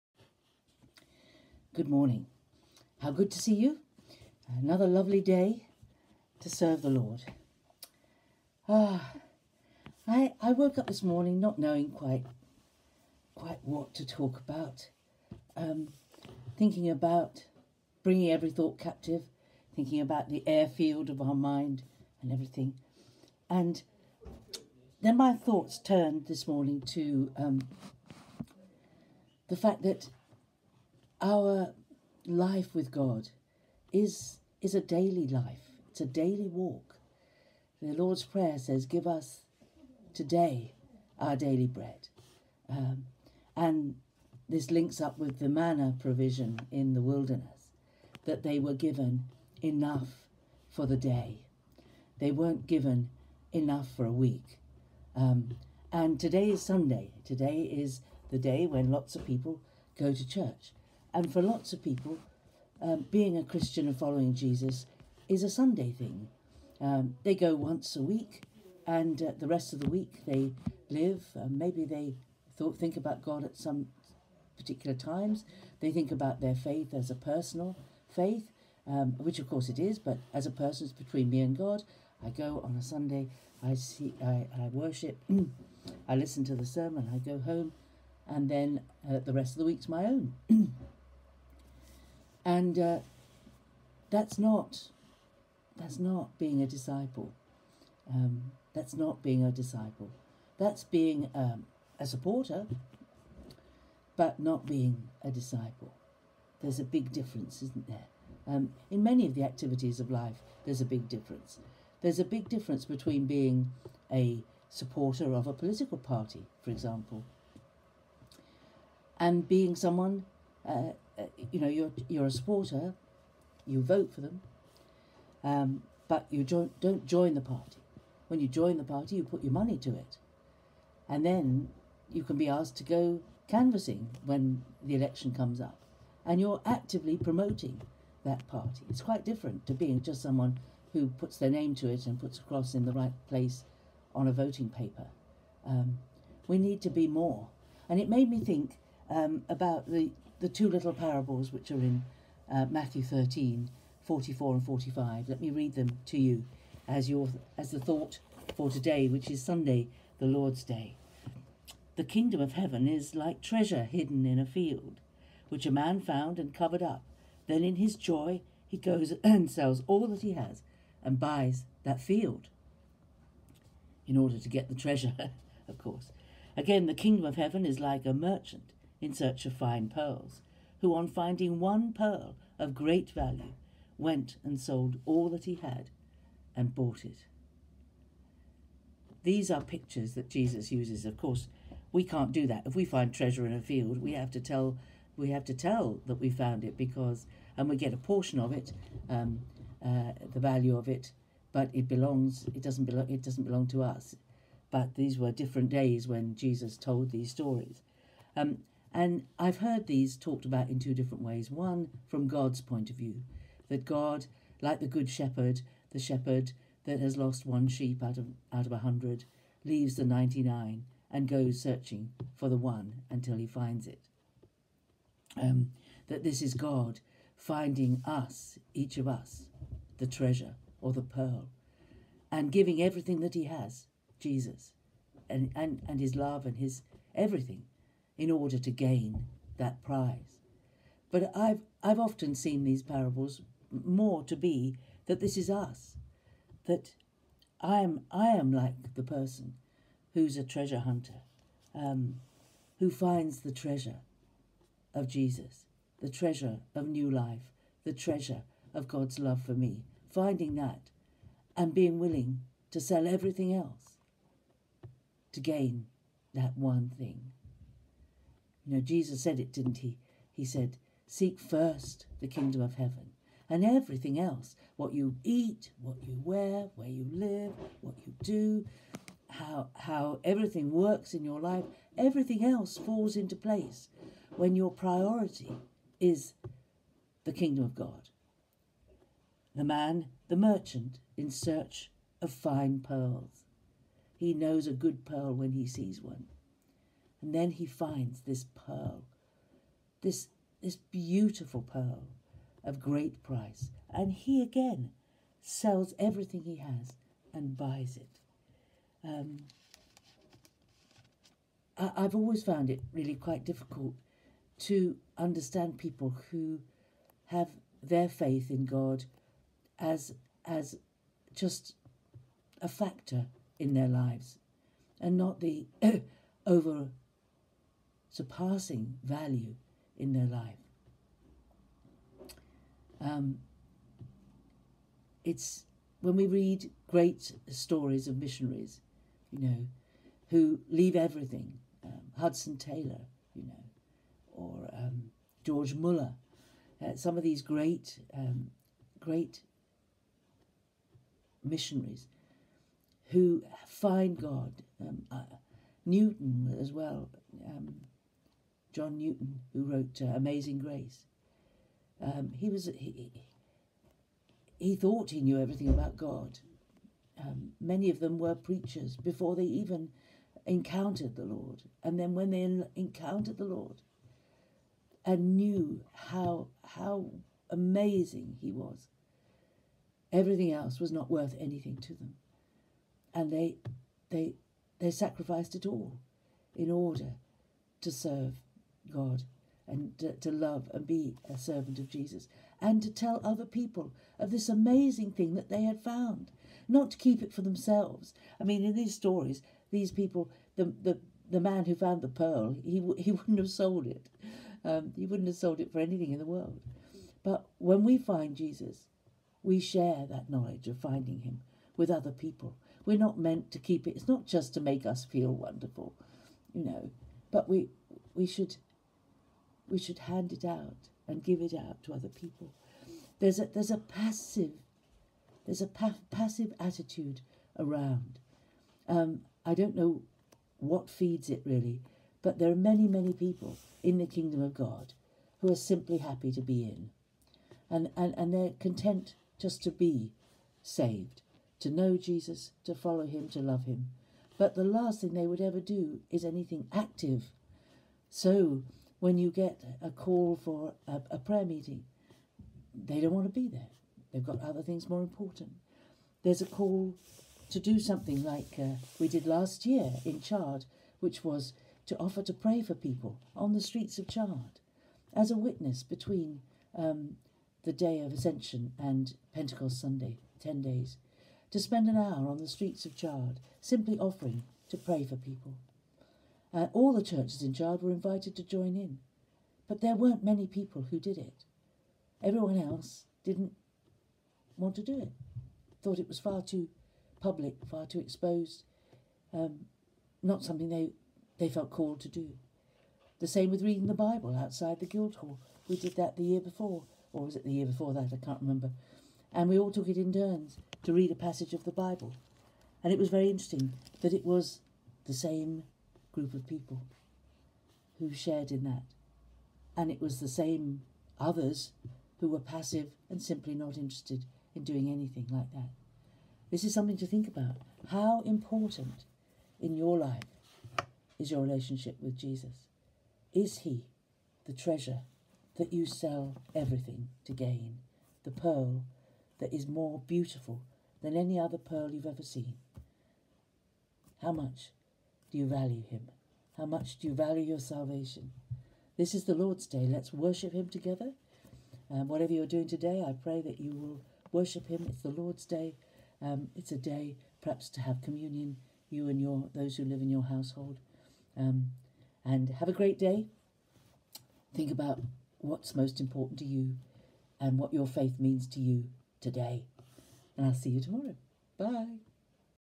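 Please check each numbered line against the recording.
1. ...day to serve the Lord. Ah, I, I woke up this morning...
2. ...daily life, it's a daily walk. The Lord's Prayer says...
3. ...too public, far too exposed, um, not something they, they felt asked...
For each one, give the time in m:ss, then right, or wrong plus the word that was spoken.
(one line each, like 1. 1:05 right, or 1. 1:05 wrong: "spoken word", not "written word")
1. 0:05 right
2. 0:34 right
3. 8:06 wrong: "called", not "asked".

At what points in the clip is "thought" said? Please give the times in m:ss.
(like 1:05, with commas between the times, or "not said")
0:18, 0:25, 1:12, 2:37, 6:04, 8:05.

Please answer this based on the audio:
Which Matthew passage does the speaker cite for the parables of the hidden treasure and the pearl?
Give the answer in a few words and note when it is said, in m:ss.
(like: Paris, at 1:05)
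Matthew 13:44-45, at 2:32.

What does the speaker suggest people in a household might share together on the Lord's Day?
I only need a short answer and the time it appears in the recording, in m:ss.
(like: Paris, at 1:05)
Communion, at 9:08.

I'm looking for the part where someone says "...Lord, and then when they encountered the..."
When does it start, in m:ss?
6:11.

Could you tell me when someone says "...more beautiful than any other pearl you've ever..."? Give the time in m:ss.
8:49.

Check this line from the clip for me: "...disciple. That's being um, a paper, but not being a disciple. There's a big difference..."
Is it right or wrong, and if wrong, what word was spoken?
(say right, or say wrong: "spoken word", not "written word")
wrong: "supporter", not "paper".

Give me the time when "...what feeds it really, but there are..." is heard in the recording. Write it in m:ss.
7:10.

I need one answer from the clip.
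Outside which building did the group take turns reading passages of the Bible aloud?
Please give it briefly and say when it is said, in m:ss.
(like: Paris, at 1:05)
The Guildhall, at 8:14.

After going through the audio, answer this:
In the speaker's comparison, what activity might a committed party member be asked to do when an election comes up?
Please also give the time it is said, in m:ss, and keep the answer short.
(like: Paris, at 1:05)
Canvassing, at 2:13.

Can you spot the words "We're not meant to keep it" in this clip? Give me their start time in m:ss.
6:52.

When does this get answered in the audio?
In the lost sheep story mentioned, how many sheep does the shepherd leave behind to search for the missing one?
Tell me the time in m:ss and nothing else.
3:40.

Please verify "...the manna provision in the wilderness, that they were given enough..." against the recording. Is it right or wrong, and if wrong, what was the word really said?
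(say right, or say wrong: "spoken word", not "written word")
right.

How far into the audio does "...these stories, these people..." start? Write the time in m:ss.
6:38.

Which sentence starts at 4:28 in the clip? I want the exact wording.
You know, Jesus said it, didn't he?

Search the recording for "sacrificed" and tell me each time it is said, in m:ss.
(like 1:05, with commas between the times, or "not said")
6:24.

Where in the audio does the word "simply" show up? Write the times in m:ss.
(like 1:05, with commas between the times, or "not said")
7:15, 7:53, 8:33.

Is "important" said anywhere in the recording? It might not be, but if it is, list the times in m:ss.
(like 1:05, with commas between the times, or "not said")
7:35, 8:38, 9:15.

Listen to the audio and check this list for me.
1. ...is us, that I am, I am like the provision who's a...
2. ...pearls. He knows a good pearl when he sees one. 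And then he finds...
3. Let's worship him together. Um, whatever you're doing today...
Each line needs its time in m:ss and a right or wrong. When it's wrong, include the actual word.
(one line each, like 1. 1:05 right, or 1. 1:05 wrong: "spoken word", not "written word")
1. 4:05 wrong: "person", not "provision"
2. 4:52 right
3. 8:59 right.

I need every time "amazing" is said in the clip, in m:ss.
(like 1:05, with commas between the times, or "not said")
6:00, 6:17, 6:34.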